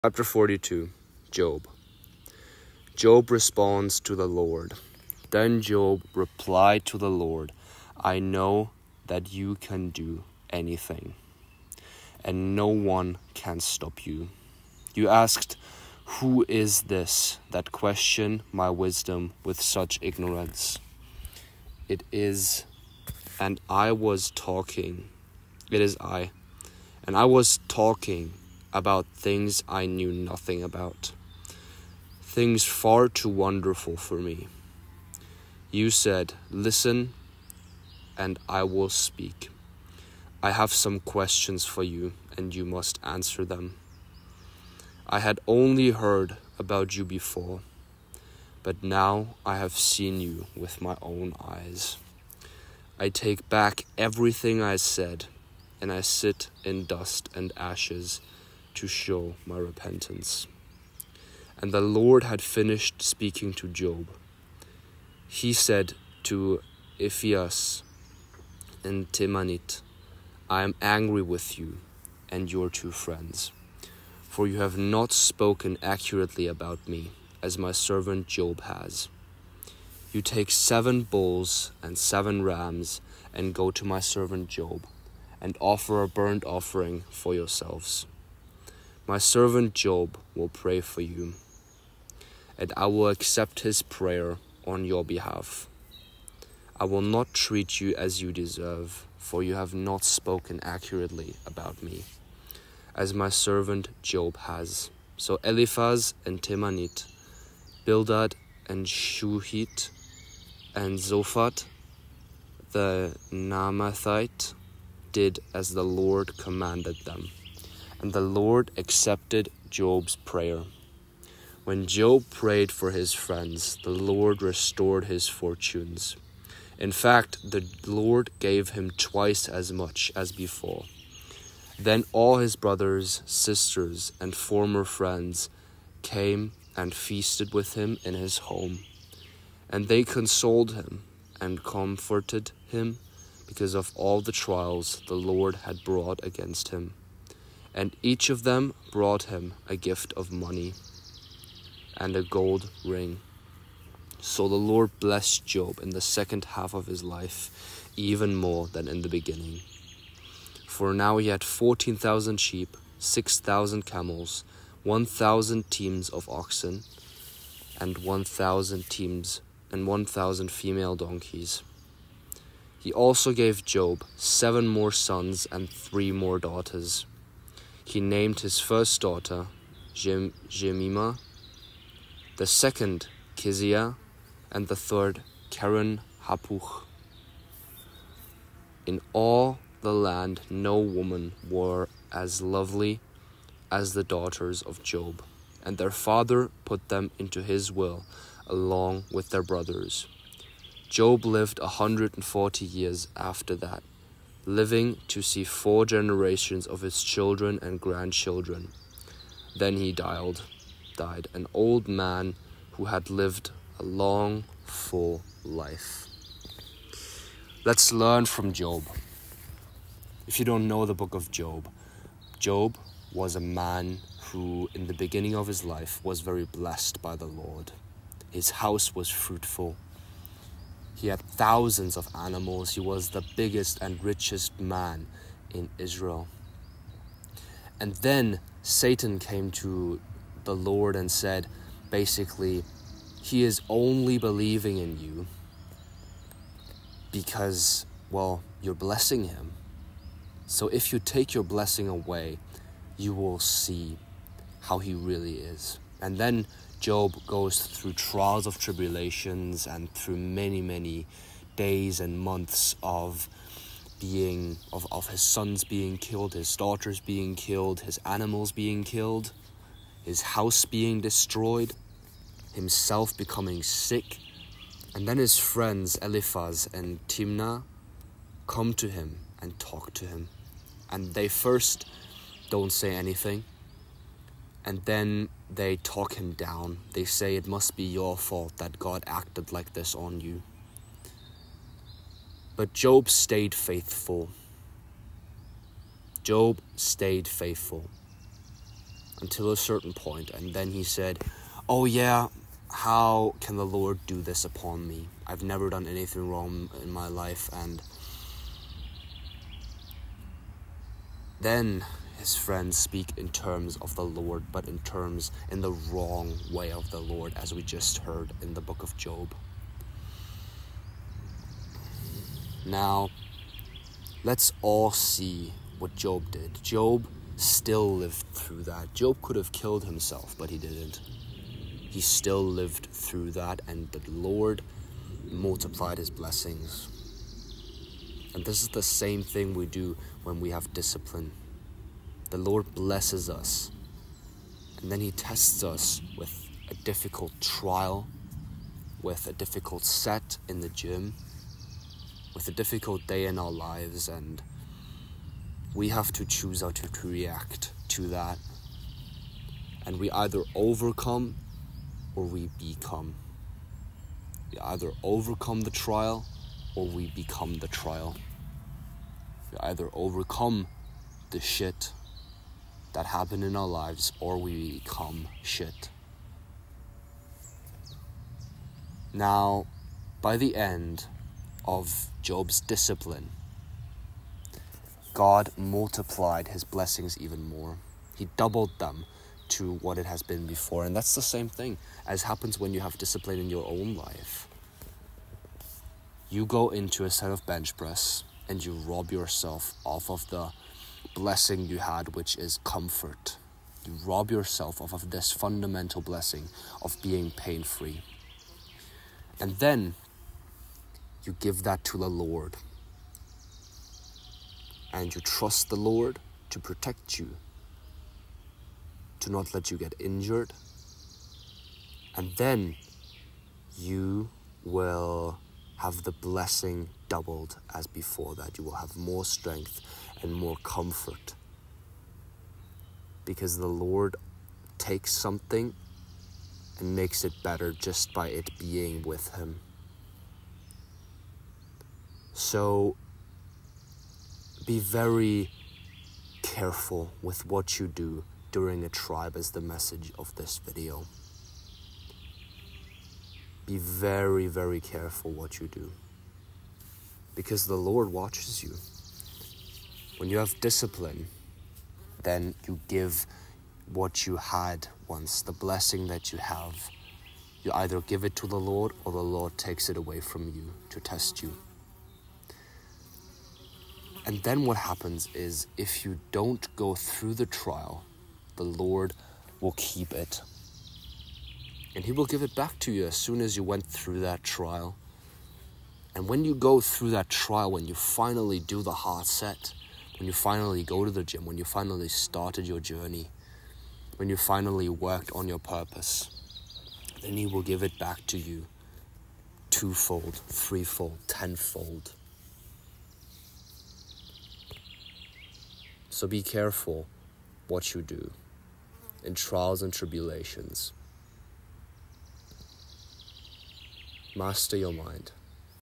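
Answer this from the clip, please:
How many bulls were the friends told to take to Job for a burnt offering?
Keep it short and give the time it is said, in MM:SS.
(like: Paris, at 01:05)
7, at 01:20.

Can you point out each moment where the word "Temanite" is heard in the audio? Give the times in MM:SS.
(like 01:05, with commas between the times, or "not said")
01:09, 01:46.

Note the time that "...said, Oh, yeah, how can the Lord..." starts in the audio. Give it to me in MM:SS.
05:00.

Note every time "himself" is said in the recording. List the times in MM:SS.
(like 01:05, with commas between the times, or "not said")
04:32, 05:29.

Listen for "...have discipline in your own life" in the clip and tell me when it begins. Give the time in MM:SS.
06:32.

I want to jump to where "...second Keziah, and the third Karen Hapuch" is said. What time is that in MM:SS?
03:02.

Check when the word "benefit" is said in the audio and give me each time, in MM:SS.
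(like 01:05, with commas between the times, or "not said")
not said.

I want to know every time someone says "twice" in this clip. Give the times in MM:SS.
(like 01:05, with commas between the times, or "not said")
02:08.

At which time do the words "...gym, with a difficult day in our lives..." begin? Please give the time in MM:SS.
05:50.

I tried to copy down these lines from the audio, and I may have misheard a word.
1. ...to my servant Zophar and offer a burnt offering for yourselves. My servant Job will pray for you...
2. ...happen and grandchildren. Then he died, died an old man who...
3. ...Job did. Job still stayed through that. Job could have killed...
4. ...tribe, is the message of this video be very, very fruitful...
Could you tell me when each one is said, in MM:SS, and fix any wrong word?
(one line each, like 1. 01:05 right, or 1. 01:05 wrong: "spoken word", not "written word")
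1. 01:23 wrong: "Job", not "Zophar"
2. 03:27 wrong: "children", not "happen"
3. 05:25 wrong: "lived", not "stayed"
4. 07:28 wrong: "careful", not "fruitful".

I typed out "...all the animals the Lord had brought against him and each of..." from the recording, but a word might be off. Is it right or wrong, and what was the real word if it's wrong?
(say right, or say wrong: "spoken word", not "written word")
wrong: "trials", not "animals".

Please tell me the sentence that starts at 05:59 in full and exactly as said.
And we either overcome or we become.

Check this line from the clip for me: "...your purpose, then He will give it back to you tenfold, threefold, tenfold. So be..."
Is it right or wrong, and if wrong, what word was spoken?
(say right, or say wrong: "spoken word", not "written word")
wrong: "twofold", not "tenfold".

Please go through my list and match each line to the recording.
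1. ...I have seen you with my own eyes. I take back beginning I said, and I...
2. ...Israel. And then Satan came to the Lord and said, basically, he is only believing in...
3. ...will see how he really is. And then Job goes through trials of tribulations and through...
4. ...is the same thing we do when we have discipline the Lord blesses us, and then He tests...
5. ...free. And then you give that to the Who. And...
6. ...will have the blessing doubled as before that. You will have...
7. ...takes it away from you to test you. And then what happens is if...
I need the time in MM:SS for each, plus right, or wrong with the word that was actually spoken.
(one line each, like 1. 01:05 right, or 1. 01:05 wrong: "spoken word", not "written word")
1. 00:49 wrong: "everything", not "beginning"
2. 03:55 right
3. 04:13 right
4. 05:38 right
5. 06:47 wrong: "Lord", not "Who"
6. 07:04 right
7. 07:49 right.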